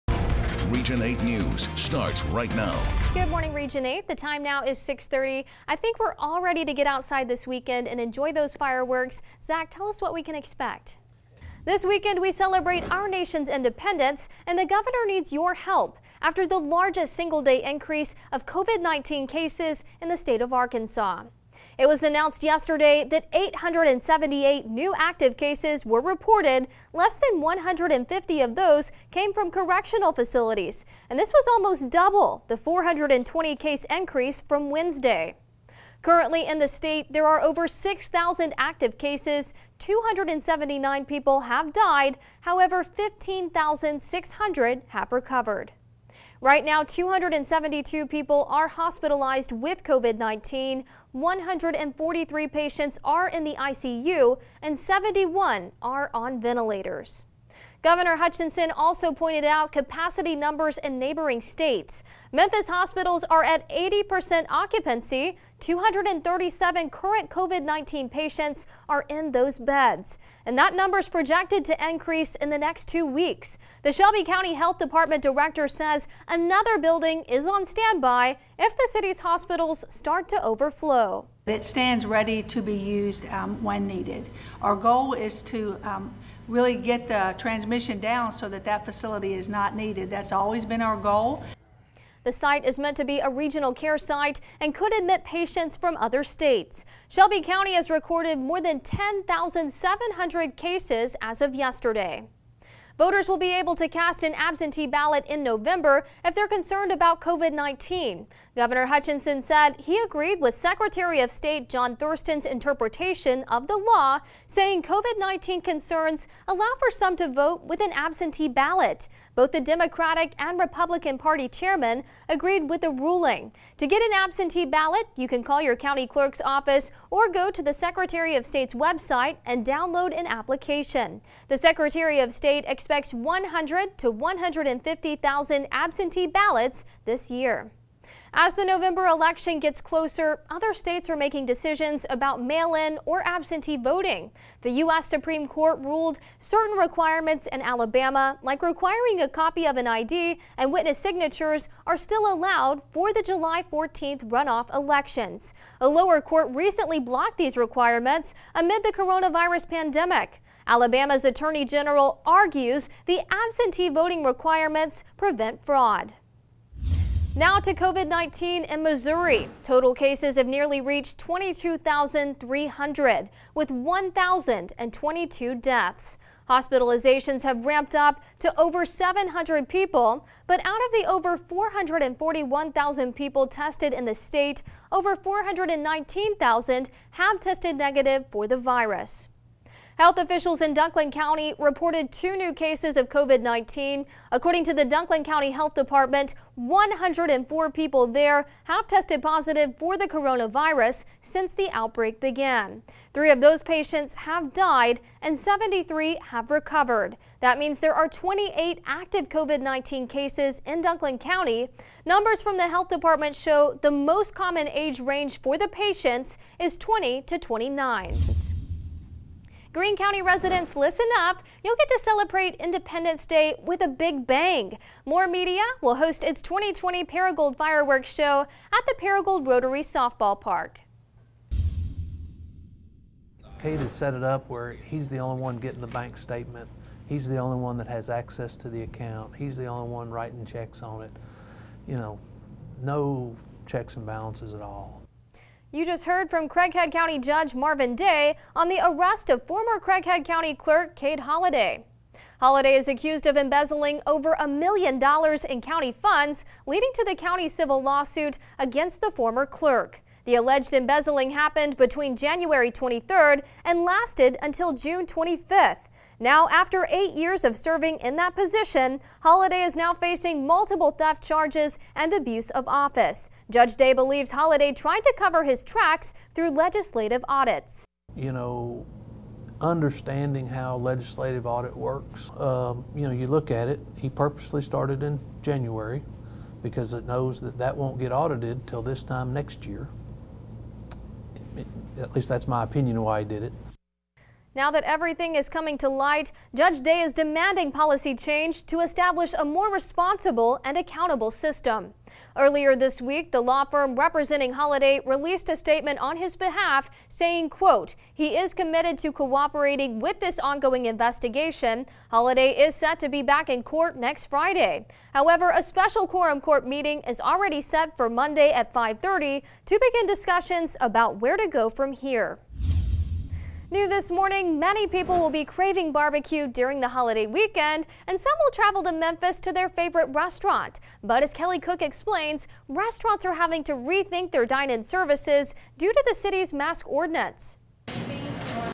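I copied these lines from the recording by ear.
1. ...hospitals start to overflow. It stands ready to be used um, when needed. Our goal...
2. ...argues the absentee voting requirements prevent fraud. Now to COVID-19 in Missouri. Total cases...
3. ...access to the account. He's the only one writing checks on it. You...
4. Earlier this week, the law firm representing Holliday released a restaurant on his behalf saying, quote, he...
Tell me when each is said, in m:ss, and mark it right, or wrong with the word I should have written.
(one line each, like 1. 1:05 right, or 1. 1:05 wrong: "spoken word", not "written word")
1. 1:19 right
2. 2:42 right
3. 3:58 right
4. 5:02 wrong: "statement", not "restaurant".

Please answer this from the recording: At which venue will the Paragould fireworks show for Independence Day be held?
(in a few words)
Paragould Rotary Softball Park.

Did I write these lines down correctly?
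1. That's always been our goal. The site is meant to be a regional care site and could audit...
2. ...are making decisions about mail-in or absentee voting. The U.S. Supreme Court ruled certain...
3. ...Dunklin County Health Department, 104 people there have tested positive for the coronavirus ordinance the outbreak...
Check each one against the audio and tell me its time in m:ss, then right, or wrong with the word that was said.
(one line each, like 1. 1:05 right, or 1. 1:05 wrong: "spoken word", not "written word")
1. 1:30 wrong: "admit", not "audit"
2. 2:21 right
3. 3:14 wrong: "since", not "ordinance".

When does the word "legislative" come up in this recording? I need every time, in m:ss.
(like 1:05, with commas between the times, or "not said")
4:36, 4:40.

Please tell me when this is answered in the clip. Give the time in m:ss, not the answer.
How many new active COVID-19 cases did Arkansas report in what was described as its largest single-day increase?
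0:23.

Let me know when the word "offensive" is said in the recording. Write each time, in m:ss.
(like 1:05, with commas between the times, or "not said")
not said.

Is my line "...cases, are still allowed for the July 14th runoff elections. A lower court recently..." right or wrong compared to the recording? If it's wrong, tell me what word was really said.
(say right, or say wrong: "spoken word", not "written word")
wrong: "signatures", not "cases".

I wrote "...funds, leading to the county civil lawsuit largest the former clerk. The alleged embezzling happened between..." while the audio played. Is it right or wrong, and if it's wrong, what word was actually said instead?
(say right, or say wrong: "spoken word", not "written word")
wrong: "against", not "largest".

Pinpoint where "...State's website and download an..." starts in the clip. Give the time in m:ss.
2:08.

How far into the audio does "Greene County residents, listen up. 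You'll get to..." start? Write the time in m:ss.
3:39.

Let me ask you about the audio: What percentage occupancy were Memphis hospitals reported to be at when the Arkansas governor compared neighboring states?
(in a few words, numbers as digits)
80%.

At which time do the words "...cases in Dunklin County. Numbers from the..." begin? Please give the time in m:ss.
3:30.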